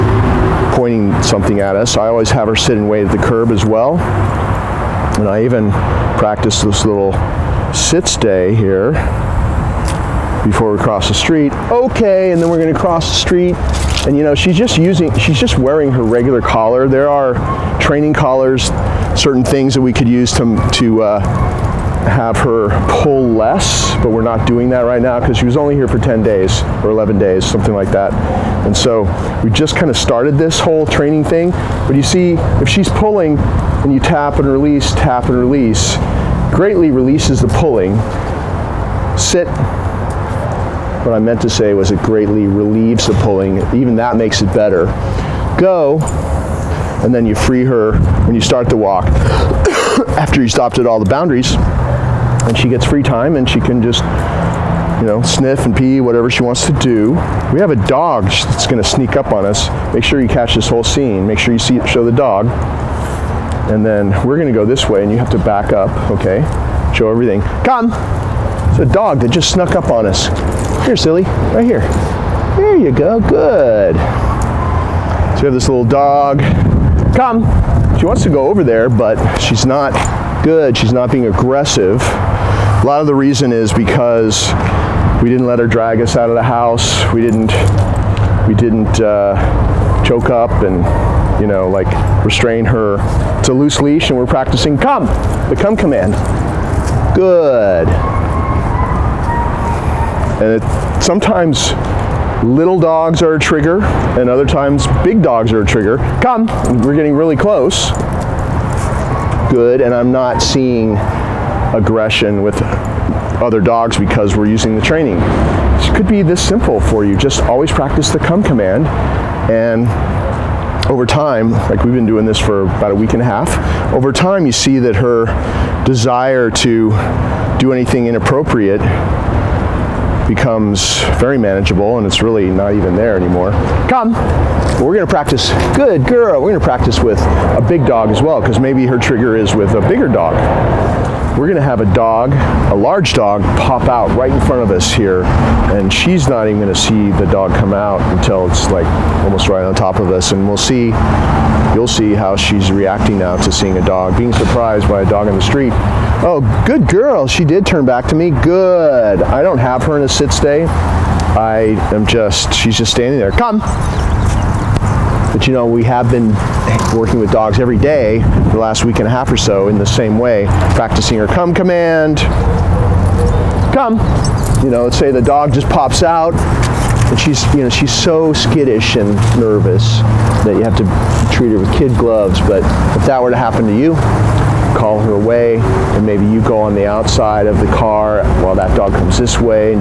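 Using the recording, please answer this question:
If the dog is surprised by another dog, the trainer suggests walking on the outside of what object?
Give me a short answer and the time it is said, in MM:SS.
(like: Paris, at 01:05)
The car, at 03:07.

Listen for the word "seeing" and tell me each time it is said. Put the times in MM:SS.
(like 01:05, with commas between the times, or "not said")
01:50, 02:33.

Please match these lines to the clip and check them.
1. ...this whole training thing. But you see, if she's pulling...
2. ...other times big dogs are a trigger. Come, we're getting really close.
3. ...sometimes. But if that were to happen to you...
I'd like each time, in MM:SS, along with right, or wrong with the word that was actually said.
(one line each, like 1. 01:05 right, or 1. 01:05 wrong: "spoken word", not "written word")
1. 00:30 right
2. 01:44 right
3. 03:01 wrong: "gloves", not "sometimes".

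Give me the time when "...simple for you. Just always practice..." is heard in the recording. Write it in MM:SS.
01:56.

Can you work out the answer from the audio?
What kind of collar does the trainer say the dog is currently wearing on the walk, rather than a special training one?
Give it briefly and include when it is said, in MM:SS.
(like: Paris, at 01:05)
Regular collar, at 00:16.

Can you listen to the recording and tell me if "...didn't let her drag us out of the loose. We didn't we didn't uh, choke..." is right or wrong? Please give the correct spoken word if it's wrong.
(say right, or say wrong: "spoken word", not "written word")
wrong: "house", not "loose".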